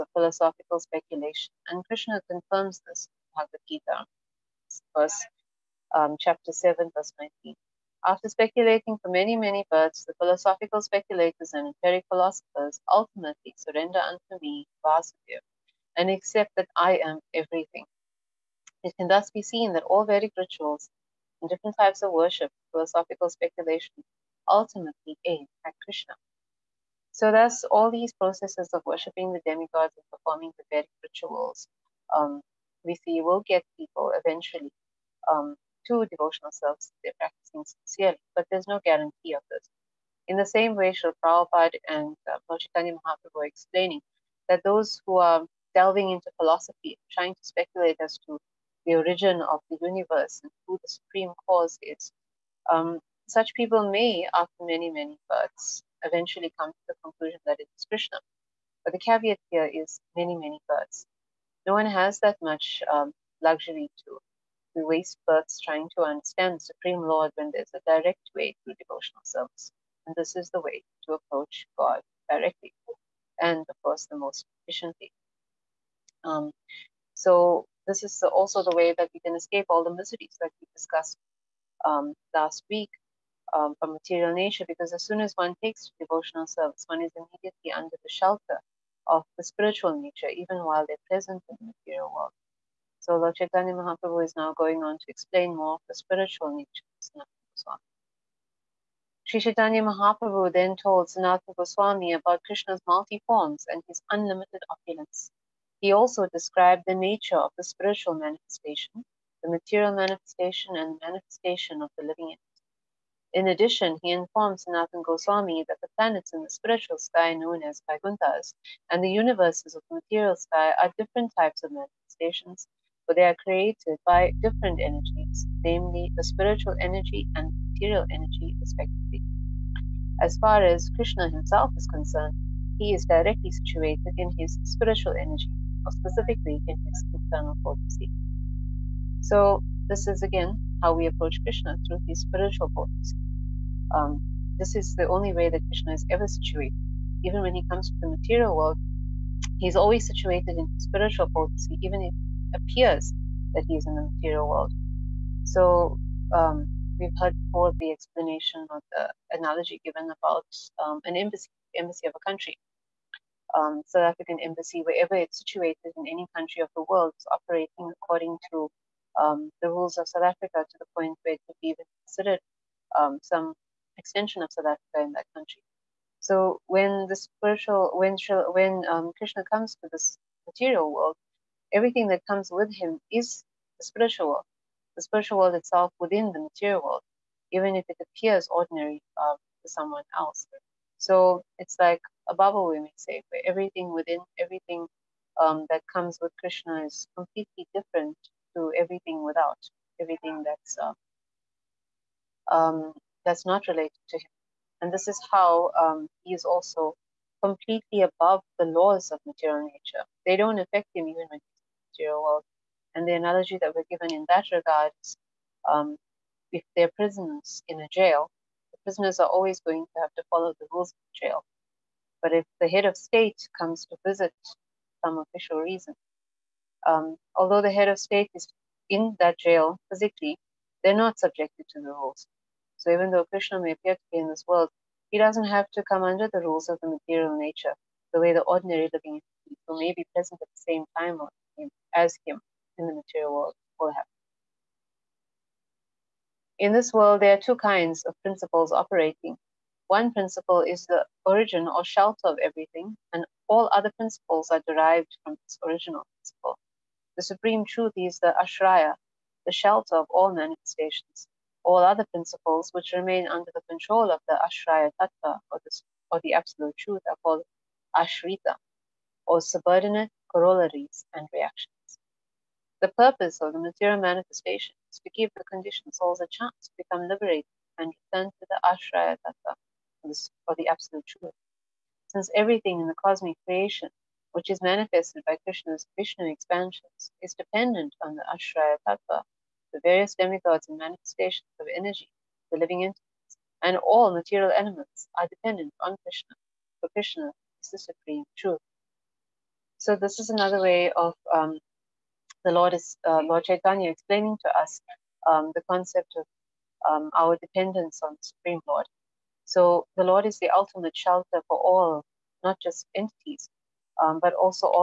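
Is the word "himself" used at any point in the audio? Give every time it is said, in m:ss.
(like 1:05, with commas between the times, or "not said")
2:11.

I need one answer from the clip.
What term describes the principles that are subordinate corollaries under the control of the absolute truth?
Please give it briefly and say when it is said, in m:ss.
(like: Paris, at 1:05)
ashrita, at 4:27.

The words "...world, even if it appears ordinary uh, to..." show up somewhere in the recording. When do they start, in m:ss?
3:06.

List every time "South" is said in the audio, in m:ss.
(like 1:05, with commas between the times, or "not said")
2:43, 2:50, 2:54.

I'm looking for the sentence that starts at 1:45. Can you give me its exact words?
He also described the nature of the spiritual manifestation, the material manifestation, and the manifestation of the living entity.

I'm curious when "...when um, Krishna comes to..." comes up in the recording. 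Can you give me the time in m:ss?
2:58.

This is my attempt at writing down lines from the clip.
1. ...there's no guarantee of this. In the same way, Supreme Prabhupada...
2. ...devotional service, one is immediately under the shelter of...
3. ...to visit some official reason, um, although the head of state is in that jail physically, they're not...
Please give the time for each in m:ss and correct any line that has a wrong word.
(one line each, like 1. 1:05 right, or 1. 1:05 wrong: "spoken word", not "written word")
1. 0:38 wrong: "Srila", not "Supreme"
2. 1:25 right
3. 3:43 right.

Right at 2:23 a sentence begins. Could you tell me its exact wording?
Um, this is the only way that Krishna is ever situated.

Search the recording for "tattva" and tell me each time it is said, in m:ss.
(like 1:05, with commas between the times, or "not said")
4:24, 4:39, 4:48.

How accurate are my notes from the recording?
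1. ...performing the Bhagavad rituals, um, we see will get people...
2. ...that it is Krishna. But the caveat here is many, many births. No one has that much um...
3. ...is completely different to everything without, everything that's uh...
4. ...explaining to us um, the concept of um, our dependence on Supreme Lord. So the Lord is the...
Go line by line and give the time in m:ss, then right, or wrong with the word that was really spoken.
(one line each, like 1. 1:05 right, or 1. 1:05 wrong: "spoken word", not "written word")
1. 0:30 wrong: "Vedic", not "Bhagavad"
2. 0:57 right
3. 3:16 right
4. 5:03 right.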